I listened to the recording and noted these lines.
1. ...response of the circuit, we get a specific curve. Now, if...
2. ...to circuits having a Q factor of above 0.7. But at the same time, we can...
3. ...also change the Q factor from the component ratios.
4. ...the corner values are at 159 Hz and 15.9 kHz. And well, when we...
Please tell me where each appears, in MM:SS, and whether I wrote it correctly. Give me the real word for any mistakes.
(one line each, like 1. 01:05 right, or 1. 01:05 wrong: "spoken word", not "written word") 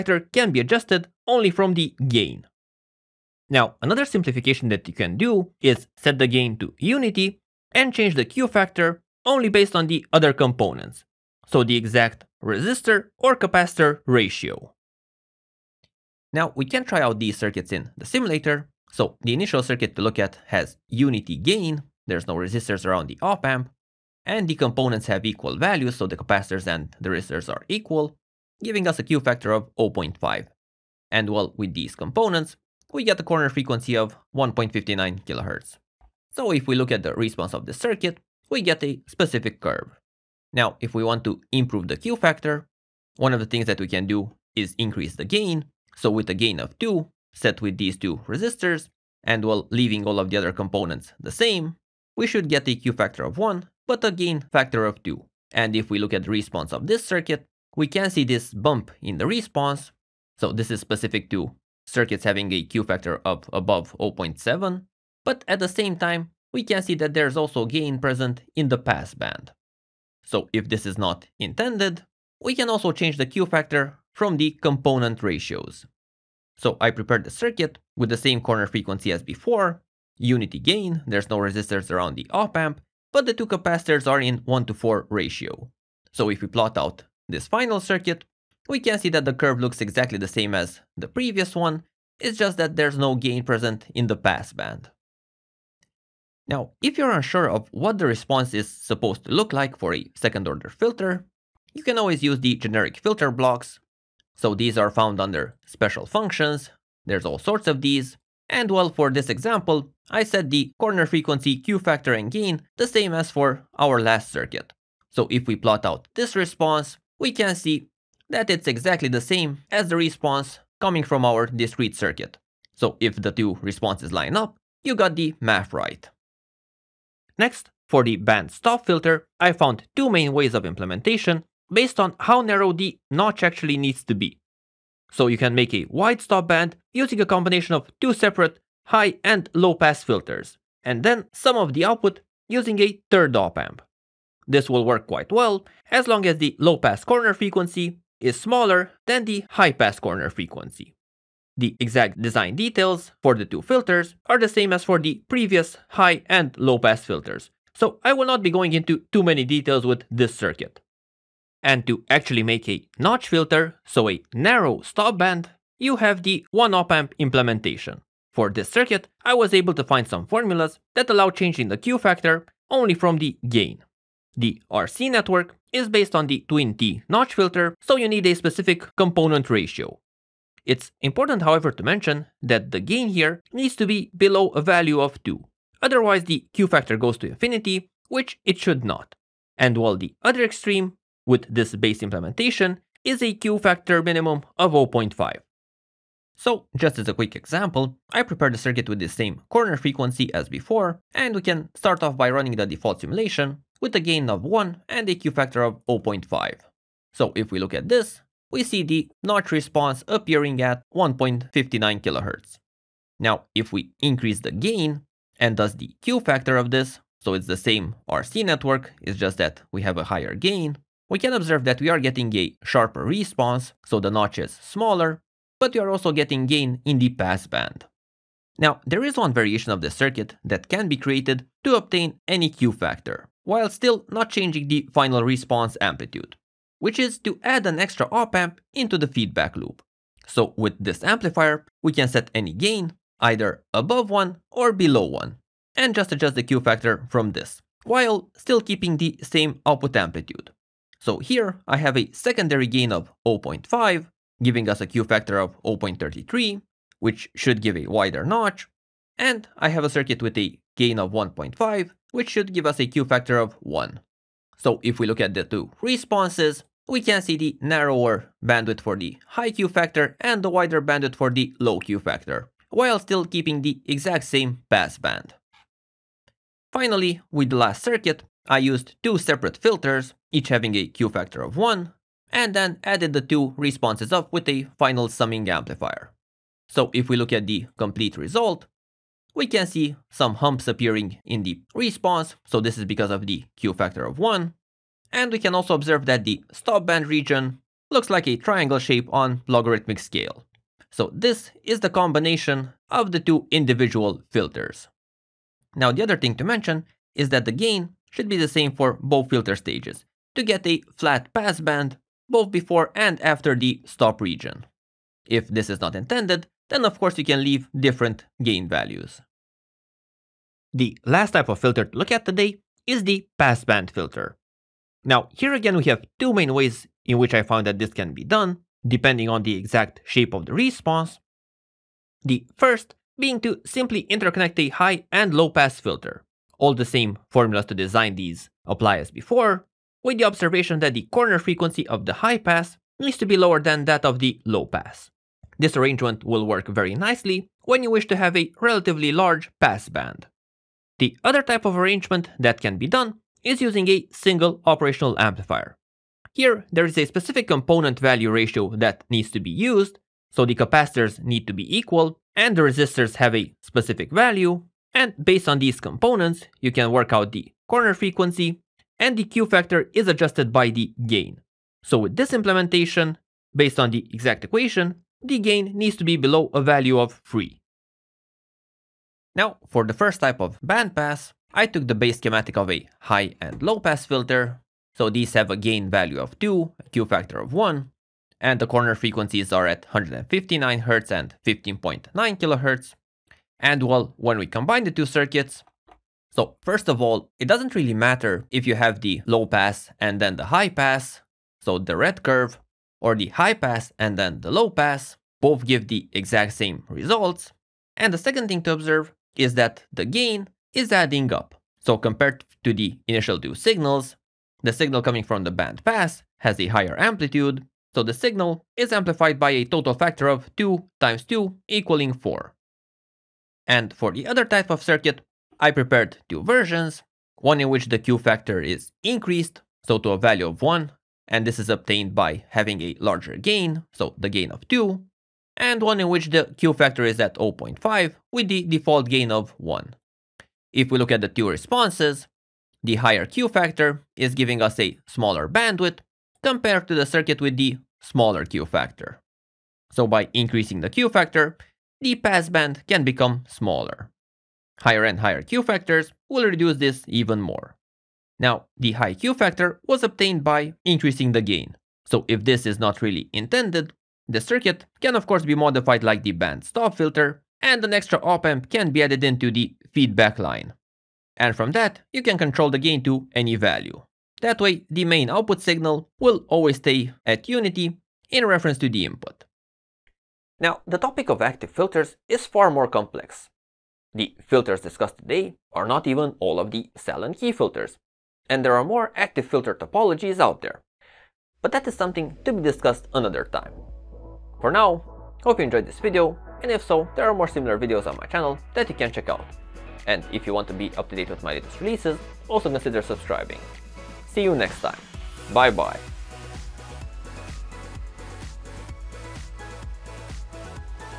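1. 00:37 right
2. 01:01 right
3. 01:12 right
4. 06:28 wrong: "frequencies", not "values".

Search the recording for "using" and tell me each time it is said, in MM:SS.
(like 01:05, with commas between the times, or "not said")
02:16, 02:22, 05:53.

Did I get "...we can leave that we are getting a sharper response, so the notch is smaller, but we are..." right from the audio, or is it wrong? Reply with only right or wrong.
wrong.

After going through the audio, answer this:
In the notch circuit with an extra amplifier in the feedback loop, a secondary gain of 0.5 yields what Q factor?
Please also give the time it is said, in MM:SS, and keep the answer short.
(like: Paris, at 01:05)
0.33, at 04:15.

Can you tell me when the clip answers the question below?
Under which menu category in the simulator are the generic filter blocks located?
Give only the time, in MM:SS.
01:45.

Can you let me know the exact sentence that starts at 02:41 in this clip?
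And to actually make a notch filter, so a narrow stop band, you have the one op amp implementation.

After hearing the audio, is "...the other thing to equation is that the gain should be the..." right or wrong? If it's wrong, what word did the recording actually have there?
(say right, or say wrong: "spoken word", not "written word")
wrong: "mention", not "equation".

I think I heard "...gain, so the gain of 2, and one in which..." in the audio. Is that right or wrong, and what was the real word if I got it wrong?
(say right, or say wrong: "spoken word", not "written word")
right.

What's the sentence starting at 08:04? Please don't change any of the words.
The filters discussed today are not even all of the Sallen Key filters, and there are more active filter topologies out there.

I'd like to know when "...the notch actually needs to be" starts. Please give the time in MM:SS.
02:12.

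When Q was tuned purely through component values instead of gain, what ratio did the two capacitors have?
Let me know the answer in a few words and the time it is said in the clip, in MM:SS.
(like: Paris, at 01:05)
1 to 4, at 01:24.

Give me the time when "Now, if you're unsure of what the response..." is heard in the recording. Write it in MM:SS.
01:36.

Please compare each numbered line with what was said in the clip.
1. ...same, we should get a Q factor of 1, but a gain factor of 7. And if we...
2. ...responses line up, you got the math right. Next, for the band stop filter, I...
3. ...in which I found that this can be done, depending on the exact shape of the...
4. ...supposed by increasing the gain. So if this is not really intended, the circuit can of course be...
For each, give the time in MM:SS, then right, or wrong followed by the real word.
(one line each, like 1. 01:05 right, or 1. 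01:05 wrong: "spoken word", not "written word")
1. 00:51 wrong: "2", not "7"
2. 02:03 right
3. 05:27 right
4. 07:40 wrong: "obtained", not "supposed".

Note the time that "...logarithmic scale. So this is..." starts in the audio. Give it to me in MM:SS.
04:59.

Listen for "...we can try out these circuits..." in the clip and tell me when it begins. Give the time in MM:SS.
00:16.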